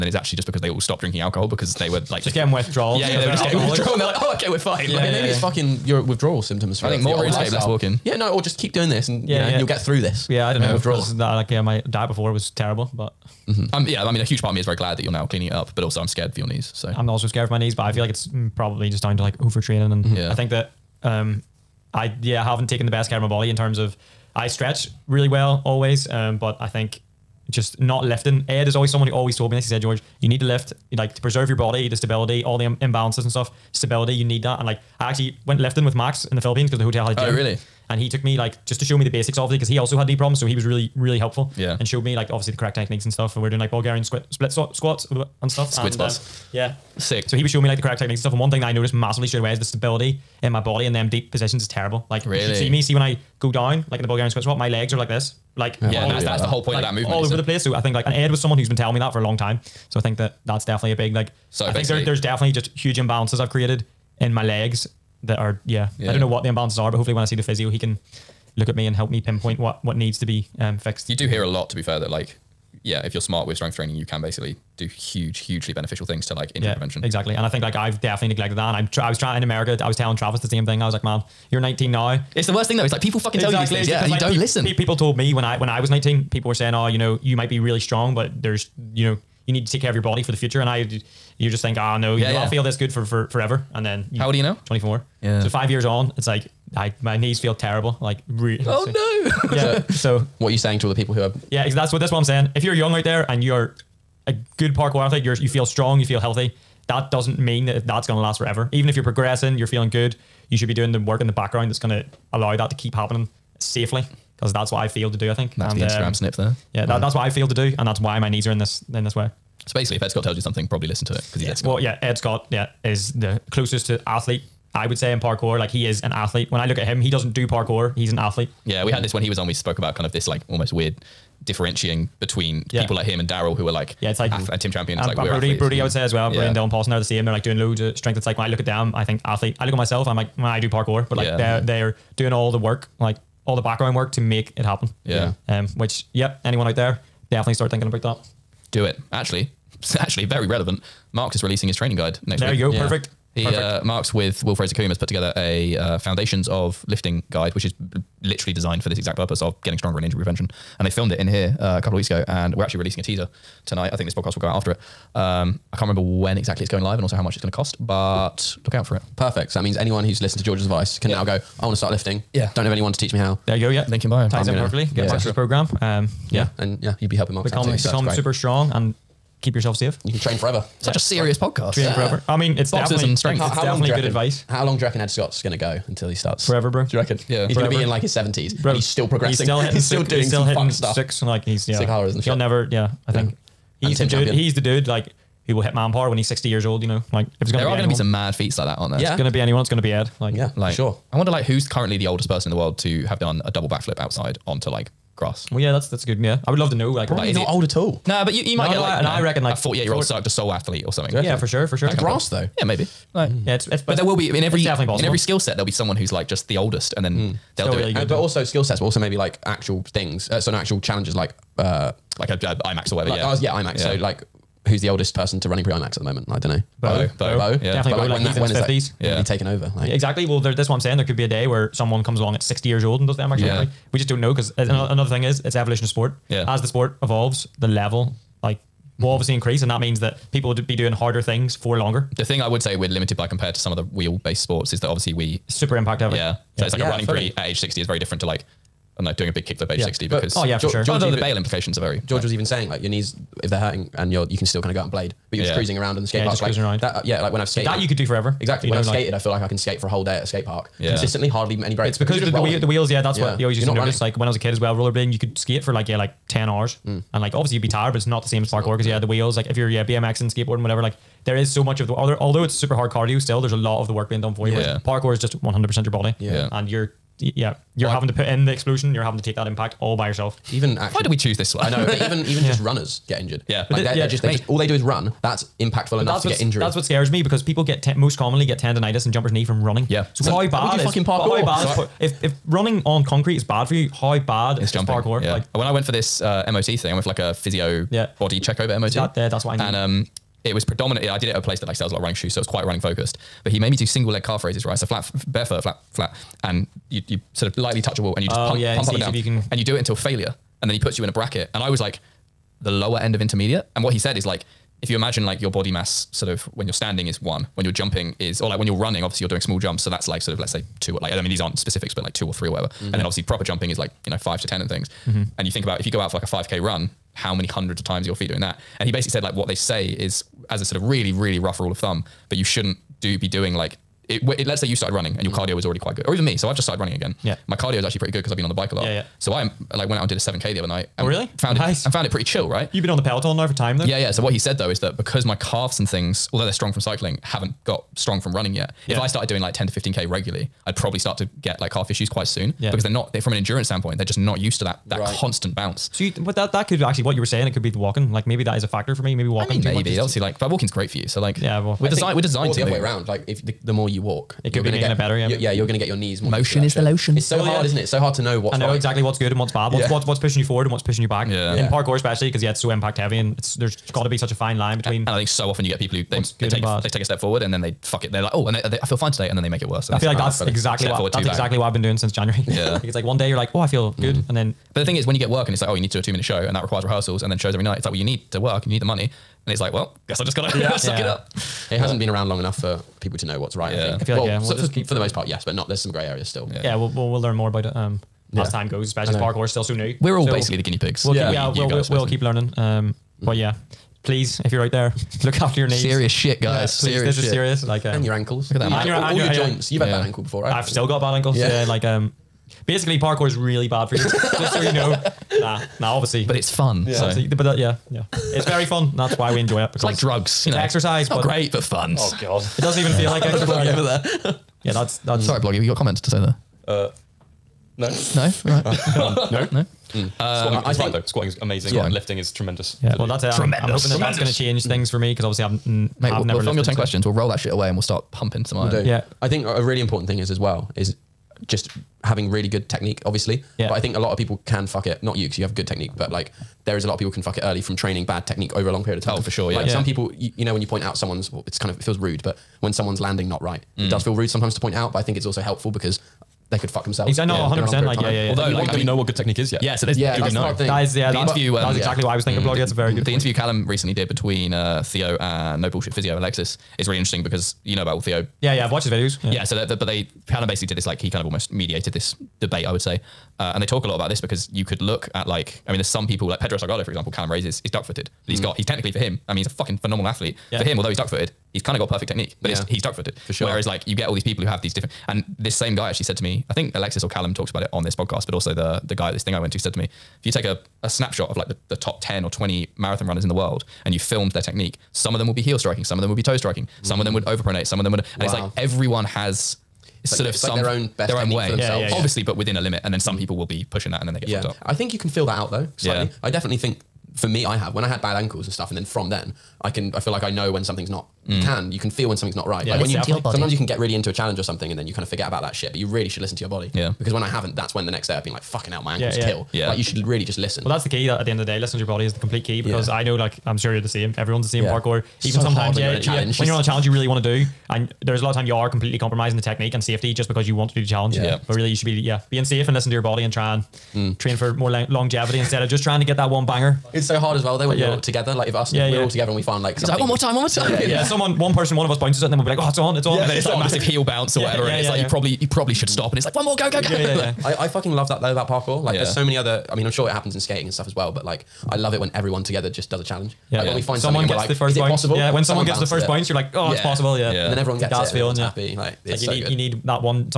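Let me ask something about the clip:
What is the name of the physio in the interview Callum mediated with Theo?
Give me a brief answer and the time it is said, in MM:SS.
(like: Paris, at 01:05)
No Bullshit Physio Alexis, at 07:45.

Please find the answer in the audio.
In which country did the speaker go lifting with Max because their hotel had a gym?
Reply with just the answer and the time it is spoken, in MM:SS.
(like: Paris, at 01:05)
the Philippines, at 00:36.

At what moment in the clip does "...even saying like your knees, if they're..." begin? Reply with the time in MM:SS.
04:12.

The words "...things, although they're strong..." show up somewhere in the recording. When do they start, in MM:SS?
05:45.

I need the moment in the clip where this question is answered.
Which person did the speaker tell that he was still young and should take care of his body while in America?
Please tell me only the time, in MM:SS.
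01:20.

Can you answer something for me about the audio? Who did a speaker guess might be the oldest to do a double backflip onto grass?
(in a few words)
Cirque du Soleil athlete.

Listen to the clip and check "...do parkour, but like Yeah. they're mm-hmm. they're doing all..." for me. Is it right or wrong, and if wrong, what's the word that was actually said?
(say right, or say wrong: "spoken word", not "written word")
right.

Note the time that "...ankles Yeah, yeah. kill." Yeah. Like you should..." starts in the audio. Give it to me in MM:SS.
08:38.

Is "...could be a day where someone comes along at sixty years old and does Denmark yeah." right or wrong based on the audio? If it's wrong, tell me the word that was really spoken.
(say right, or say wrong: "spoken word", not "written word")
right.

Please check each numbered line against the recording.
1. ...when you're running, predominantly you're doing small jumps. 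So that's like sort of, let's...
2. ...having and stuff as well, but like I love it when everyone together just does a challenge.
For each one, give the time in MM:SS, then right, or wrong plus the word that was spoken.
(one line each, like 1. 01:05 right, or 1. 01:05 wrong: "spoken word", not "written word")
1. 05:18 wrong: "obviously", not "predominantly"
2. 09:10 wrong: "skating", not "having".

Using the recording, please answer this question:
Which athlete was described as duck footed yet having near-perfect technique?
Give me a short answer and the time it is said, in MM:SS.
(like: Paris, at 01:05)
Pedro Salgado, at 07:56.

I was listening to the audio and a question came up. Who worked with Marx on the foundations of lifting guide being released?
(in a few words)
Will Fraser Coombe.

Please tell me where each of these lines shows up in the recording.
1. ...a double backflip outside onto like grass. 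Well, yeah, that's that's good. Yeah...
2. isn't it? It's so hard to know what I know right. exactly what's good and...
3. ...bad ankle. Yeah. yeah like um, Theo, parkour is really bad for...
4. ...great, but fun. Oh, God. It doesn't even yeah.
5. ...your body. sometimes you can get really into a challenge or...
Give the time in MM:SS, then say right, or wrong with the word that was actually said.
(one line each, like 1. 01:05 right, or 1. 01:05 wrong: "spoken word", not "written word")
1. 03:23 right
2. 06:07 right
3. 06:50 wrong: "Basically", not "Theo"
4. 07:01 right
5. 08:33 right.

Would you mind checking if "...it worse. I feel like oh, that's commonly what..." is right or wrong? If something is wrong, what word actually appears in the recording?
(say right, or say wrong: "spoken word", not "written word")
wrong: "exactly", not "commonly".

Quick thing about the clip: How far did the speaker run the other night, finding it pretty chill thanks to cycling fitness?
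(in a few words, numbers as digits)
7k.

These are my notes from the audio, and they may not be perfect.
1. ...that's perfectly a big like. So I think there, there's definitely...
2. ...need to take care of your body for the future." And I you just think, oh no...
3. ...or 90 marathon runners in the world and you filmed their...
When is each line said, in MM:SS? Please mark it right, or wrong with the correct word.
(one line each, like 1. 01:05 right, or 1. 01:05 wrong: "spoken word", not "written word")
1. 01:00 wrong: "definitely", not "perfectly"
2. 01:29 right
3. 08:12 wrong: "20", not "90".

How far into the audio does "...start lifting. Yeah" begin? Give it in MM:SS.
02:51.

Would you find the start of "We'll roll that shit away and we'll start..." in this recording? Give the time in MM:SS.
07:17.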